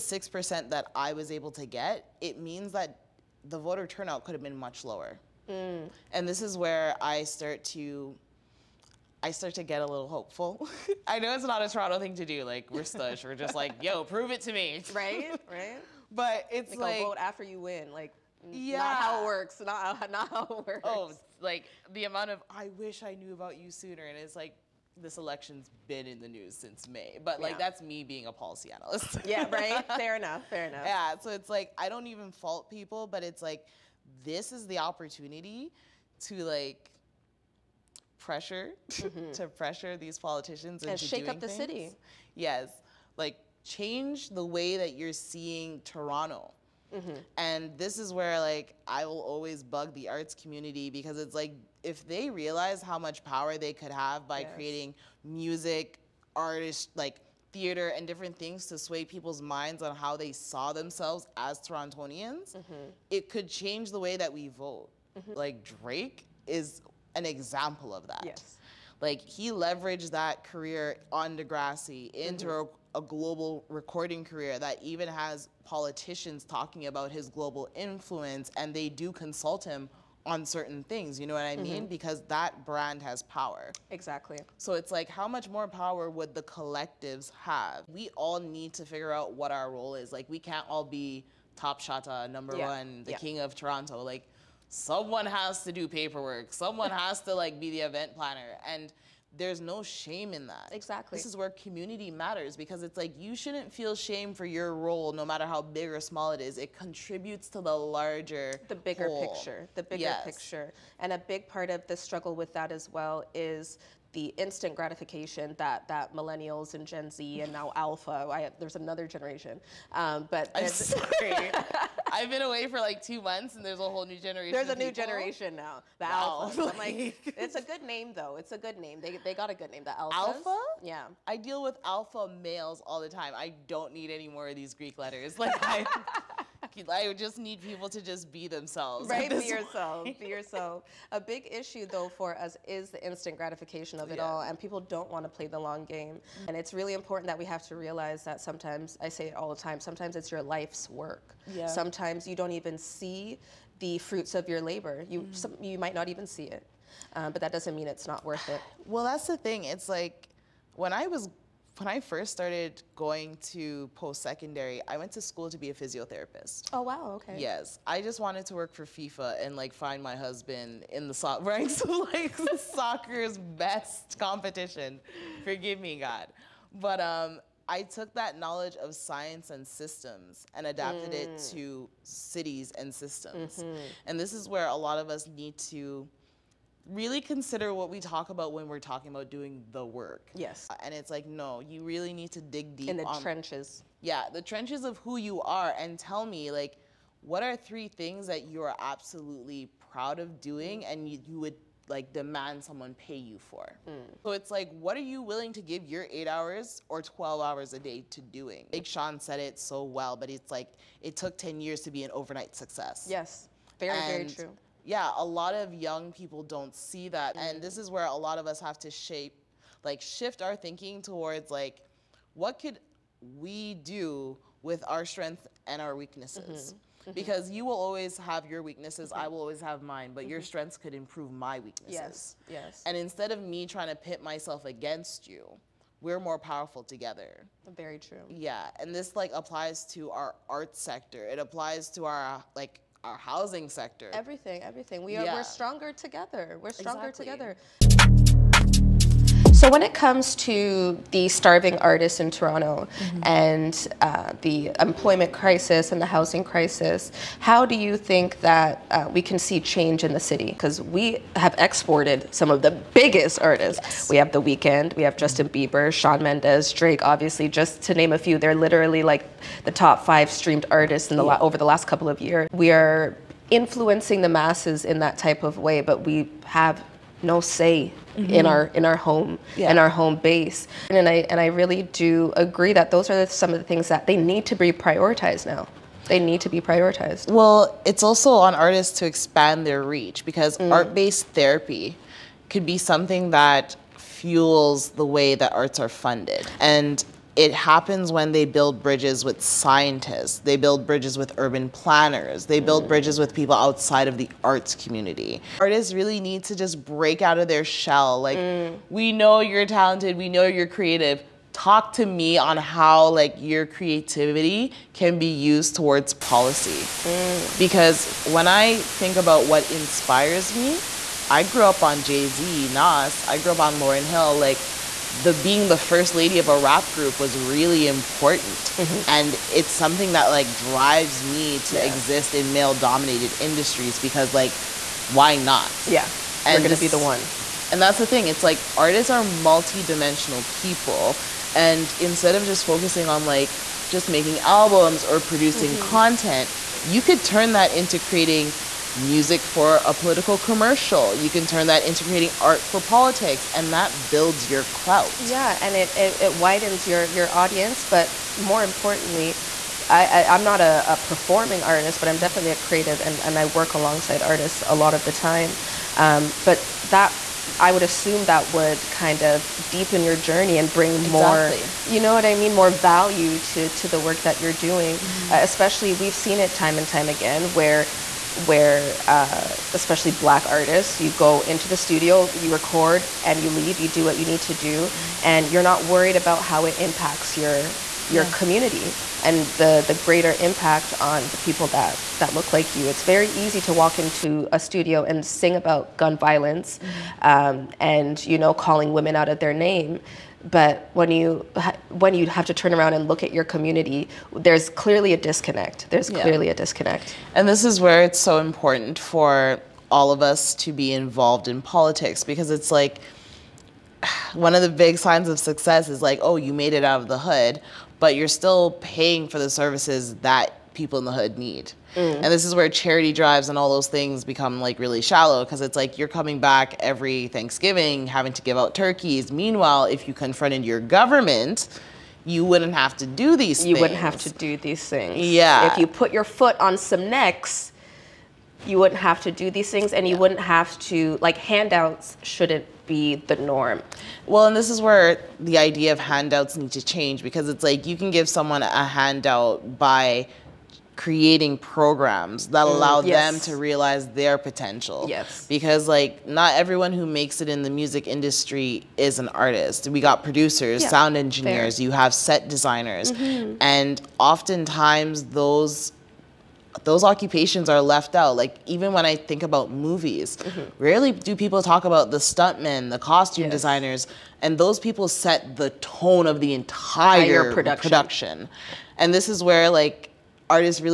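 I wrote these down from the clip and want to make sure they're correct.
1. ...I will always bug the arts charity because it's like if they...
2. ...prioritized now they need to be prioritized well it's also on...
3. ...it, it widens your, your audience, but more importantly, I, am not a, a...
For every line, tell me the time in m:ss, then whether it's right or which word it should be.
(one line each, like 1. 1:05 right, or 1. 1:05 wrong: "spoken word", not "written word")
1. 0:48 wrong: "community", not "charity"
2. 4:44 right
3. 5:55 right.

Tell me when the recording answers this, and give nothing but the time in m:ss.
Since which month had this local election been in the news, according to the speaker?
0:26.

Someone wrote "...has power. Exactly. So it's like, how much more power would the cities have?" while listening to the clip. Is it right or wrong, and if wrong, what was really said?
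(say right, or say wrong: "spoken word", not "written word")
wrong: "collectives", not "cities".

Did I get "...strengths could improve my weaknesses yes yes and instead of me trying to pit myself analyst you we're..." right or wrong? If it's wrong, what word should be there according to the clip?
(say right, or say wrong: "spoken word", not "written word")
wrong: "against", not "analyst".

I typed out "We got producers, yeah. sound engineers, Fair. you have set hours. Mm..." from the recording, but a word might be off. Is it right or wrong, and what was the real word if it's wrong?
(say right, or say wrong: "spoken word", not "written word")
wrong: "designers", not "hours".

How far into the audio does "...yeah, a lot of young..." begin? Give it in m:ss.
3:34.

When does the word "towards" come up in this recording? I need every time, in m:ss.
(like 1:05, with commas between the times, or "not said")
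3:41, 5:15.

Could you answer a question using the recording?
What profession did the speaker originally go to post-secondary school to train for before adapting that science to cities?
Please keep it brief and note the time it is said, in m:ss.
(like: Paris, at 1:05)
Physiotherapist, at 2:45.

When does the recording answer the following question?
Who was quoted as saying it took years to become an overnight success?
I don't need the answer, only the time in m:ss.
3:28.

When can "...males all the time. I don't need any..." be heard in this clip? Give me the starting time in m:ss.
2:12.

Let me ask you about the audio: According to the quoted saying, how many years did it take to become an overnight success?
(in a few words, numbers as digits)
10 years.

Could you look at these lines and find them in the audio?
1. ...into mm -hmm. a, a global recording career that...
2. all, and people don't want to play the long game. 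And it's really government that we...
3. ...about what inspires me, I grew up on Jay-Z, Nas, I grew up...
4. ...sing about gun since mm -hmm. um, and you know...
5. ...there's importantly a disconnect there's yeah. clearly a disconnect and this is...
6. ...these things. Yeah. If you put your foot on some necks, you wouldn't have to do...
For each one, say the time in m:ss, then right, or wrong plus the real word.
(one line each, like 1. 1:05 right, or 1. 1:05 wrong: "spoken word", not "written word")
1. 1:12 right
2. 2:24 wrong: "important", not "government"
3. 5:19 right
4. 6:35 wrong: "violence", not "since"
5. 6:44 wrong: "clearly", not "importantly"
6. 7:14 right.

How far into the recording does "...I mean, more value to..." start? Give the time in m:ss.
6:12.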